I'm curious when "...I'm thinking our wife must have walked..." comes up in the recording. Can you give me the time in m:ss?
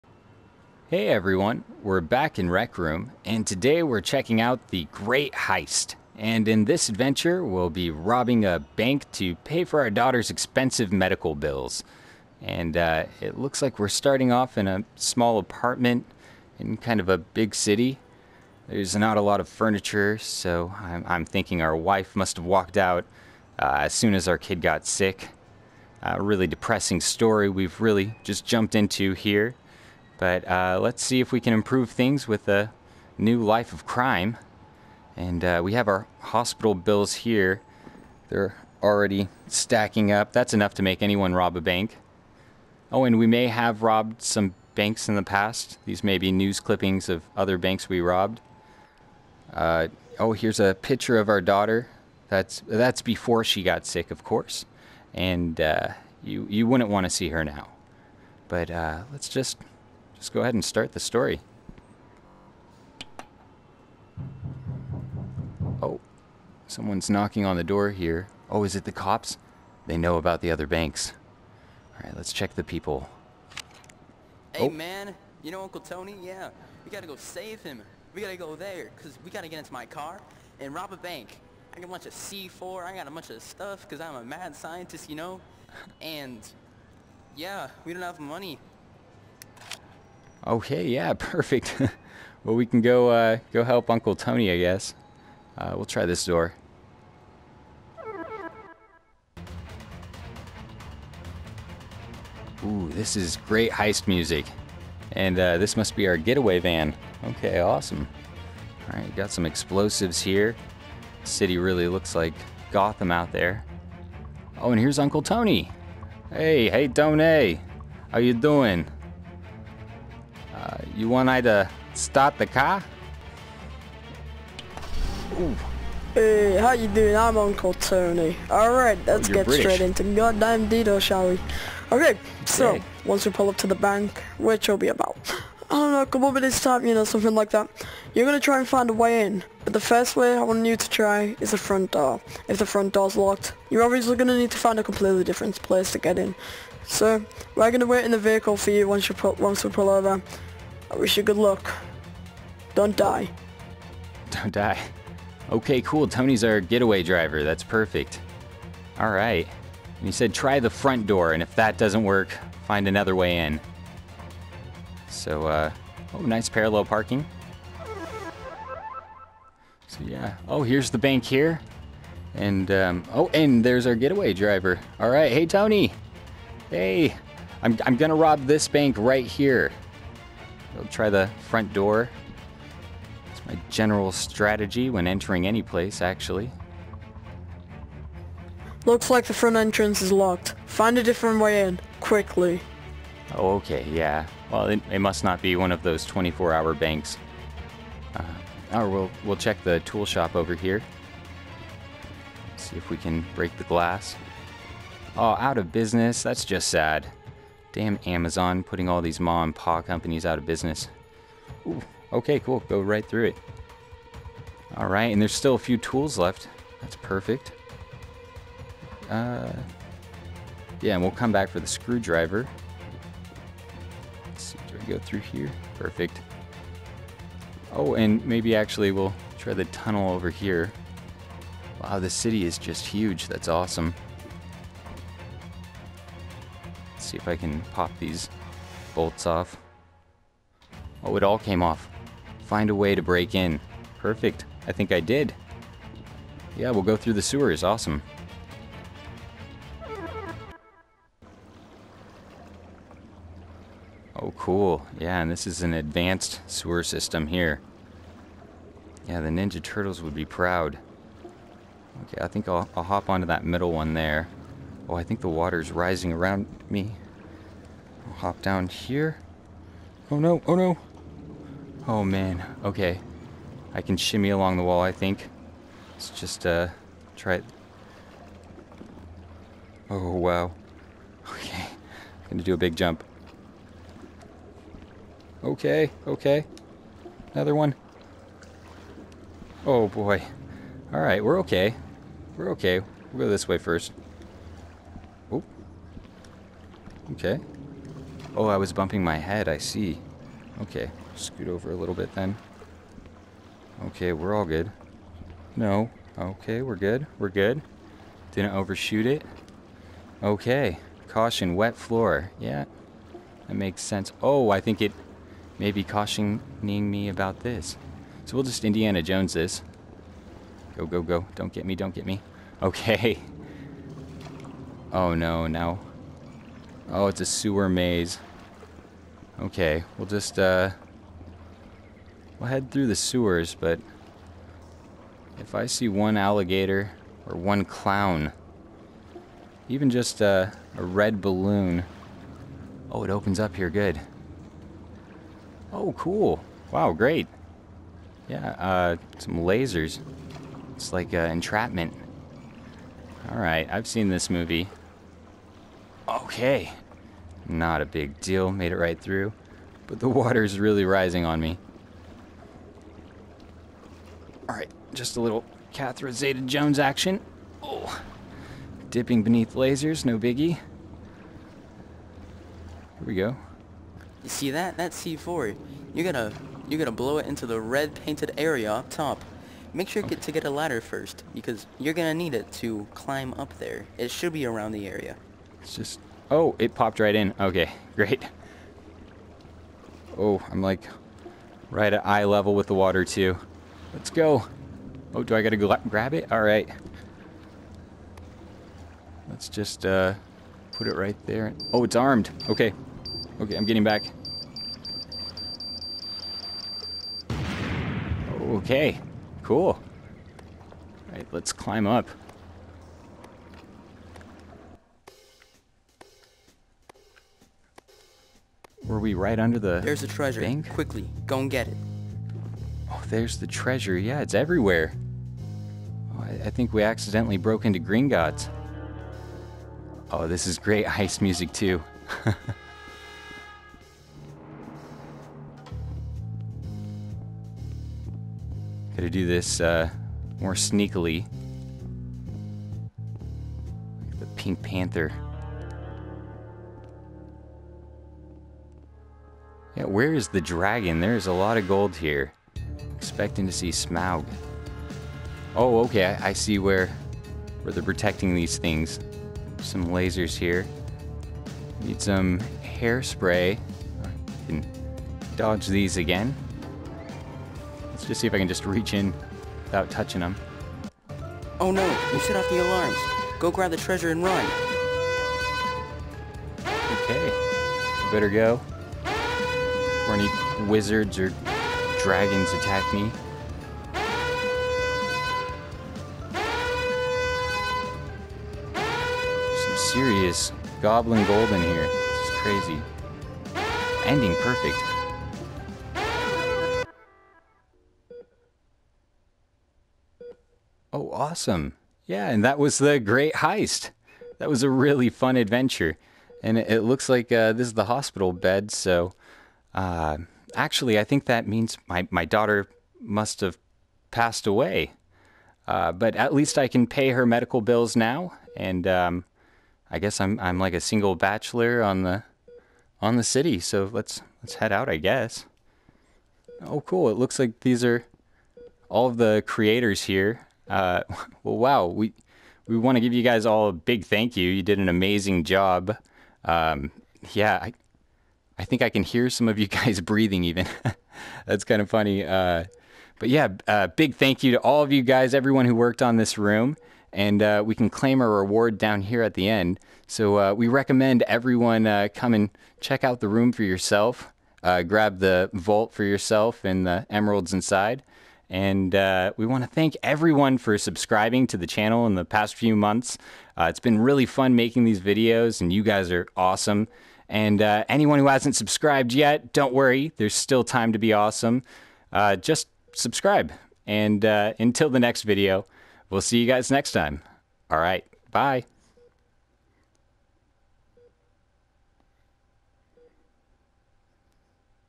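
0:21.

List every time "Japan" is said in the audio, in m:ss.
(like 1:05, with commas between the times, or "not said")
not said.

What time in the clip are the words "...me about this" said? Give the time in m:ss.
5:16.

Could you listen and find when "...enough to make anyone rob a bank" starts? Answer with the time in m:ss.
0:40.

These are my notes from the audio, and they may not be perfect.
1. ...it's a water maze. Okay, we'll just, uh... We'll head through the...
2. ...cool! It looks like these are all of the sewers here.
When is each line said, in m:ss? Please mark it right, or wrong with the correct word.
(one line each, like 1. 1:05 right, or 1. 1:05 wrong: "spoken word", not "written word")
1. 5:27 wrong: "sewer", not "water"
2. 8:46 wrong: "creators", not "sewers".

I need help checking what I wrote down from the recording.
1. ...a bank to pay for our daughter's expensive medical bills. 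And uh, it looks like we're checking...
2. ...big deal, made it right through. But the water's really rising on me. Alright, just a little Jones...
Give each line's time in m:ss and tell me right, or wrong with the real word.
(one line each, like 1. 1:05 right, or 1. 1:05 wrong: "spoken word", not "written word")
1. 0:08 wrong: "starting", not "checking"
2. 5:57 wrong: "Catherine", not "Jones".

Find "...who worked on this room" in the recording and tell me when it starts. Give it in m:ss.
9:05.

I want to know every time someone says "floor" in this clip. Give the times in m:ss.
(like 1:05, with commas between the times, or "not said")
5:11.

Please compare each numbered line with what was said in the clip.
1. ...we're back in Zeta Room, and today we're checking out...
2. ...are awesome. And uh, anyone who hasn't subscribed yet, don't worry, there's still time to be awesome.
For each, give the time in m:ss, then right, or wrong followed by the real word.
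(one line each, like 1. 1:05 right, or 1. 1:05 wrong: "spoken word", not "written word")
1. 0:01 wrong: "Rec", not "Zeta"
2. 9:26 right.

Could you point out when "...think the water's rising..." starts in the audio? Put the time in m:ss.
4:25.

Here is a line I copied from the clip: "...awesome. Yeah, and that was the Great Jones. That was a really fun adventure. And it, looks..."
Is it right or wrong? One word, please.
wrong.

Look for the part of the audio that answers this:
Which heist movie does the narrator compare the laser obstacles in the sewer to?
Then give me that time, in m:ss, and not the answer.
5:51.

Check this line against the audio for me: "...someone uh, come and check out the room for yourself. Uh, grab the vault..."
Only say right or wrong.
wrong.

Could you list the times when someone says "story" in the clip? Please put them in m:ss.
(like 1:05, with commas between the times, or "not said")
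0:26, 1:00.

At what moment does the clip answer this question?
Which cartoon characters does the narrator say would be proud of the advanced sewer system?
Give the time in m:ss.
4:19.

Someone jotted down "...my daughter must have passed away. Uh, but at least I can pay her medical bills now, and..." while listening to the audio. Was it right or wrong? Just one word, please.
right.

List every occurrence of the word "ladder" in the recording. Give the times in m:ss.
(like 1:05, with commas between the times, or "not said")
6:20.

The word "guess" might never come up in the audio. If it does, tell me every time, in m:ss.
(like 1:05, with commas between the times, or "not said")
1:34, 8:39, 8:44.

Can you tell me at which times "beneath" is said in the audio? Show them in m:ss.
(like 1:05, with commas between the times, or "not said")
6:09.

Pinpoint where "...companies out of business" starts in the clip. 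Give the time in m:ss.
3:29.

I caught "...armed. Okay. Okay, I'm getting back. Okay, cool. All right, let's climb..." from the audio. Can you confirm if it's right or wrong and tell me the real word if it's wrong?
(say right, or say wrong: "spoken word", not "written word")
right.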